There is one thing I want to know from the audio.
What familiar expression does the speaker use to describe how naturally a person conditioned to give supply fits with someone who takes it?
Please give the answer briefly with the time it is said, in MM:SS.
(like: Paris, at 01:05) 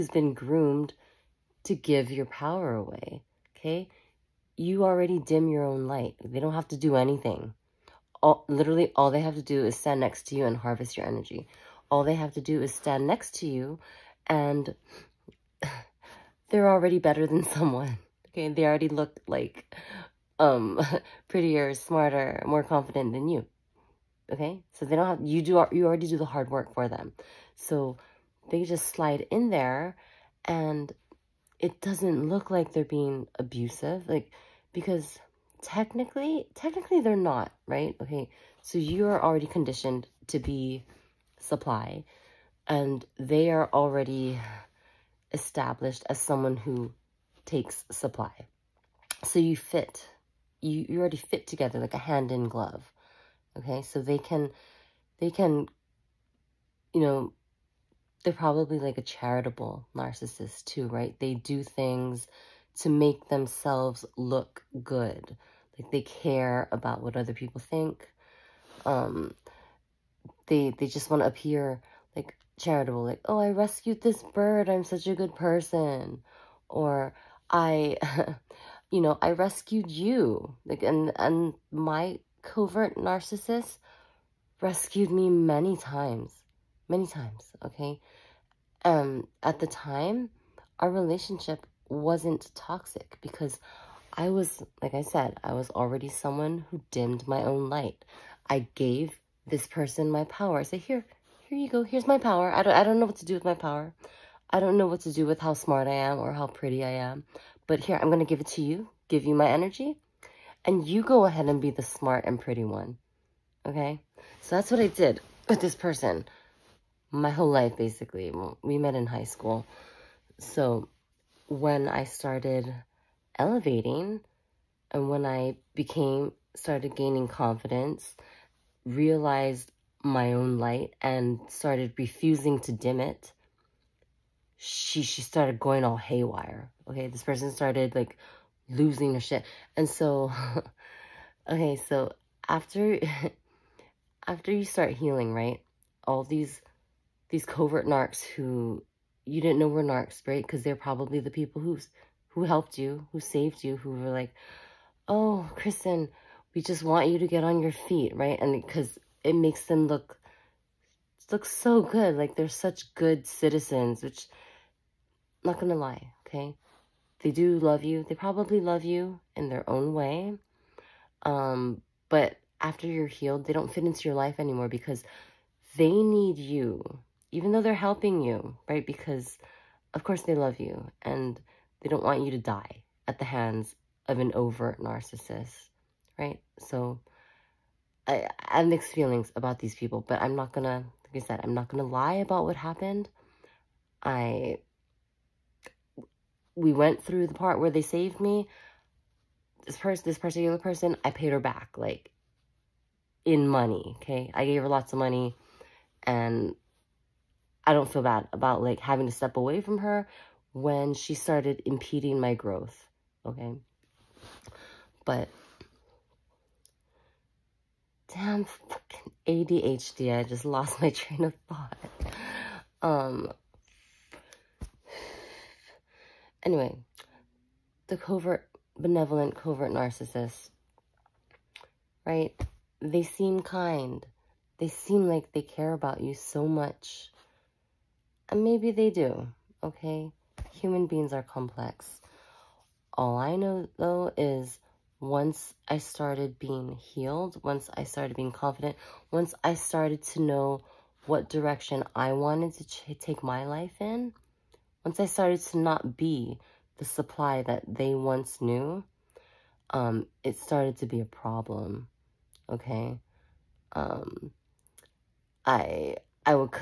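Hand in glove, at 00:52.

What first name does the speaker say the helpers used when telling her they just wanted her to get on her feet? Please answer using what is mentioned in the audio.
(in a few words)
Kristen.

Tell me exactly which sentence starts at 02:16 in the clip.
Okay, this person started like losing her shit.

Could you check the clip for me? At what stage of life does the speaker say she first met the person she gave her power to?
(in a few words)
High school.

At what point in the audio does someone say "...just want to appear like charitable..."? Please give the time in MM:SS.
01:10.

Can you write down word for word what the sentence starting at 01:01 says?
They do things to make themselves look good.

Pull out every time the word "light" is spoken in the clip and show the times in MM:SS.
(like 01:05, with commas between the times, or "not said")
00:05, 01:37, 02:10.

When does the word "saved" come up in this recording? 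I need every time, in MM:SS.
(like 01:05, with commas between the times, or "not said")
02:33, 03:17.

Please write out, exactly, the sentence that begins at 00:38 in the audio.
Okay, so you are already conditioned to be supply and they are already established as someone who takes supply.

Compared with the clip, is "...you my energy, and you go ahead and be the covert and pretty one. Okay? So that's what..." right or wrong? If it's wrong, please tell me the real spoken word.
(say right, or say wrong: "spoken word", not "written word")
wrong: "smart", not "covert".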